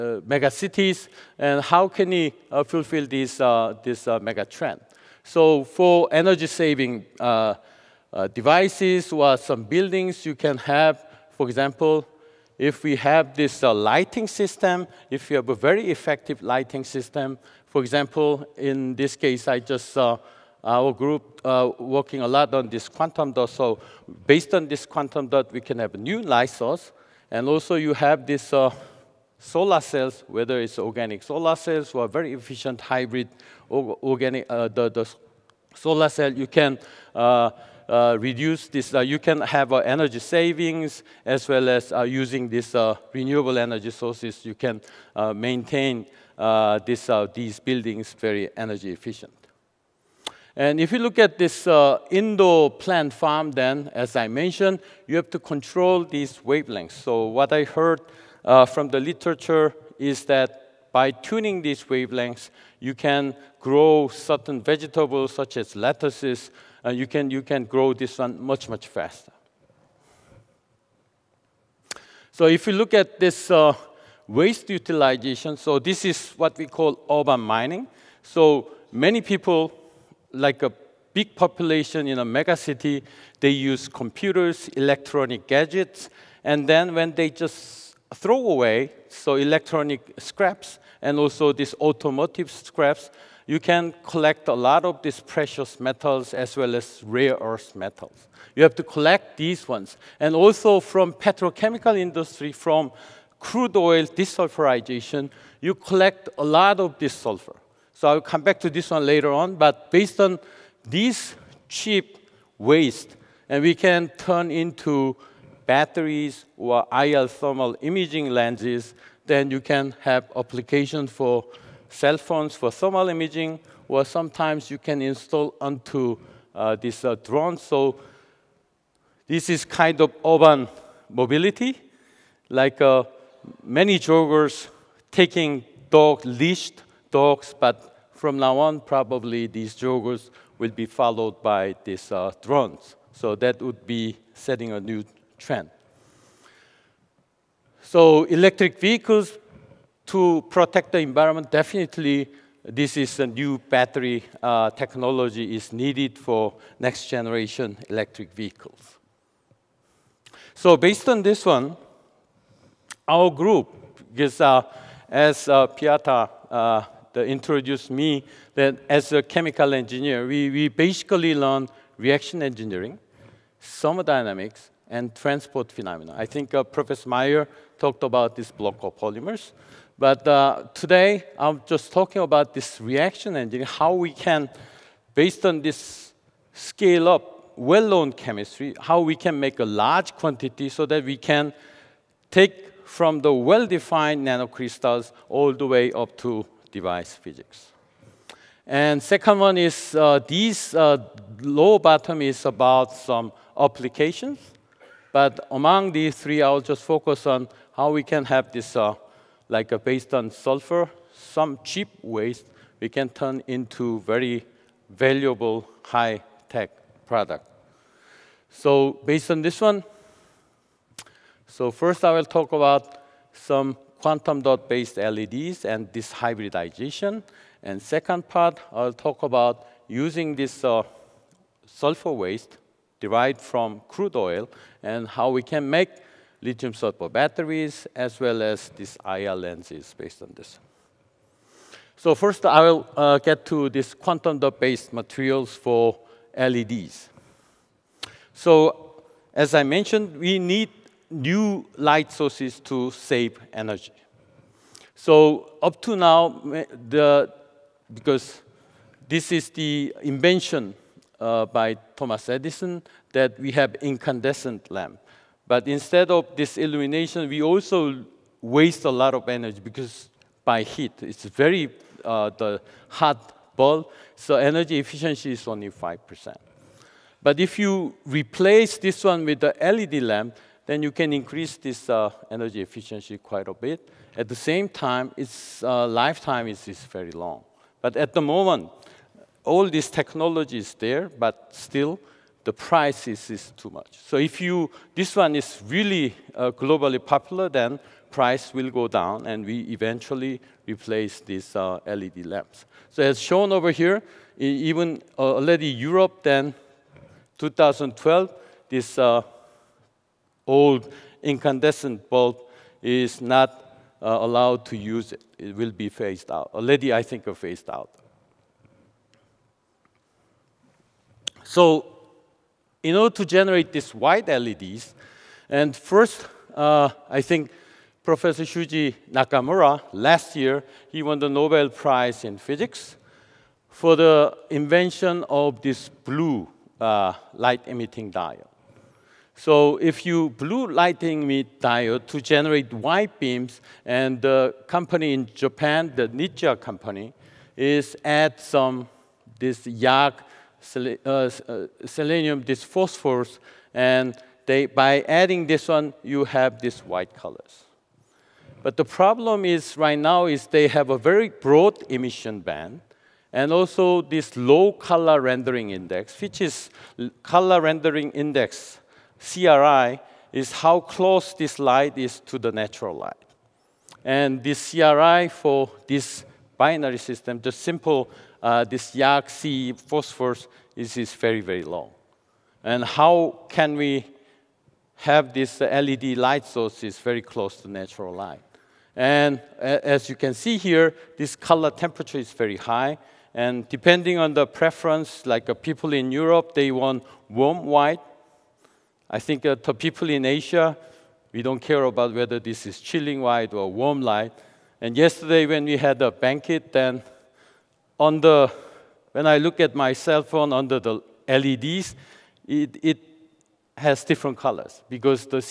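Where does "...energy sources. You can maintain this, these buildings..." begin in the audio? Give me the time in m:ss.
0:43.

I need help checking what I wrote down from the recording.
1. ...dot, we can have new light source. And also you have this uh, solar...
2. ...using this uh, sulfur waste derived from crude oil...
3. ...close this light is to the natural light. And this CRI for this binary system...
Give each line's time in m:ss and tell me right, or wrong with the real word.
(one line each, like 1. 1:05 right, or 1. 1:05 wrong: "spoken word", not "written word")
1. 0:25 right
2. 3:49 right
3. 6:10 right.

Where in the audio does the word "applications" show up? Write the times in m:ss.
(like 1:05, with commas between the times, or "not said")
2:00, 3:23.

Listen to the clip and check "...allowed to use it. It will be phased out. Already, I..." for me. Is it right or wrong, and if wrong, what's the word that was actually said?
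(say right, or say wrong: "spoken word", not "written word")
right.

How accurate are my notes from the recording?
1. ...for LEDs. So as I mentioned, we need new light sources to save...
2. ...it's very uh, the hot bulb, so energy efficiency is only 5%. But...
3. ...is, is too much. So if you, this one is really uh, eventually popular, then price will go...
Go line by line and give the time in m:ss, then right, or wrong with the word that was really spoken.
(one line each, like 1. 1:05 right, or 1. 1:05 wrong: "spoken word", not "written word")
1. 4:05 right
2. 4:31 right
3. 4:53 wrong: "globally", not "eventually".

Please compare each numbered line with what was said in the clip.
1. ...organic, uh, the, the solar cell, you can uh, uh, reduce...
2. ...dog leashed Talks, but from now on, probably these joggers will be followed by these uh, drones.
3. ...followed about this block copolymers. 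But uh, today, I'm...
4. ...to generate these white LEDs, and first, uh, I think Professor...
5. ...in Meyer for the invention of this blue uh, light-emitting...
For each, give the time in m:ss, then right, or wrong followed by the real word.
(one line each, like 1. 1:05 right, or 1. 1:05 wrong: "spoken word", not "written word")
1. 0:33 right
2. 2:15 right
3. 2:57 wrong: "talked", not "followed"
4. 5:23 right
5. 5:32 wrong: "Physics", not "Meyer".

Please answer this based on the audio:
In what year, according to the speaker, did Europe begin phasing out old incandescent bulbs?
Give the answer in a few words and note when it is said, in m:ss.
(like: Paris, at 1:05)
2012, at 5:07.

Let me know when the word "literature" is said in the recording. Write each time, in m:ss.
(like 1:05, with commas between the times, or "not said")
0:58.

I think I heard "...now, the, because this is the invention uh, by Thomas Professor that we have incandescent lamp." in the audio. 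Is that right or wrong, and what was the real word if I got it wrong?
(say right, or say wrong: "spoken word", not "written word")
wrong: "Edison", not "Professor".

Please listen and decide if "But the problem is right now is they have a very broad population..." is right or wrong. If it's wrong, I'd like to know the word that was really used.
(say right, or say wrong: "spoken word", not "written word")
wrong: "emission", not "population".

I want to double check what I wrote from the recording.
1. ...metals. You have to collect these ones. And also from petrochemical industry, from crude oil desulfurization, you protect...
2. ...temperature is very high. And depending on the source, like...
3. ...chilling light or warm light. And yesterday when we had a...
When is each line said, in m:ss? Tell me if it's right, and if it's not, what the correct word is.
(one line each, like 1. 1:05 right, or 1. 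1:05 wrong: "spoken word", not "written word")
1. 1:37 wrong: "collect", not "protect"
2. 6:31 wrong: "preference", not "source"
3. 6:42 right.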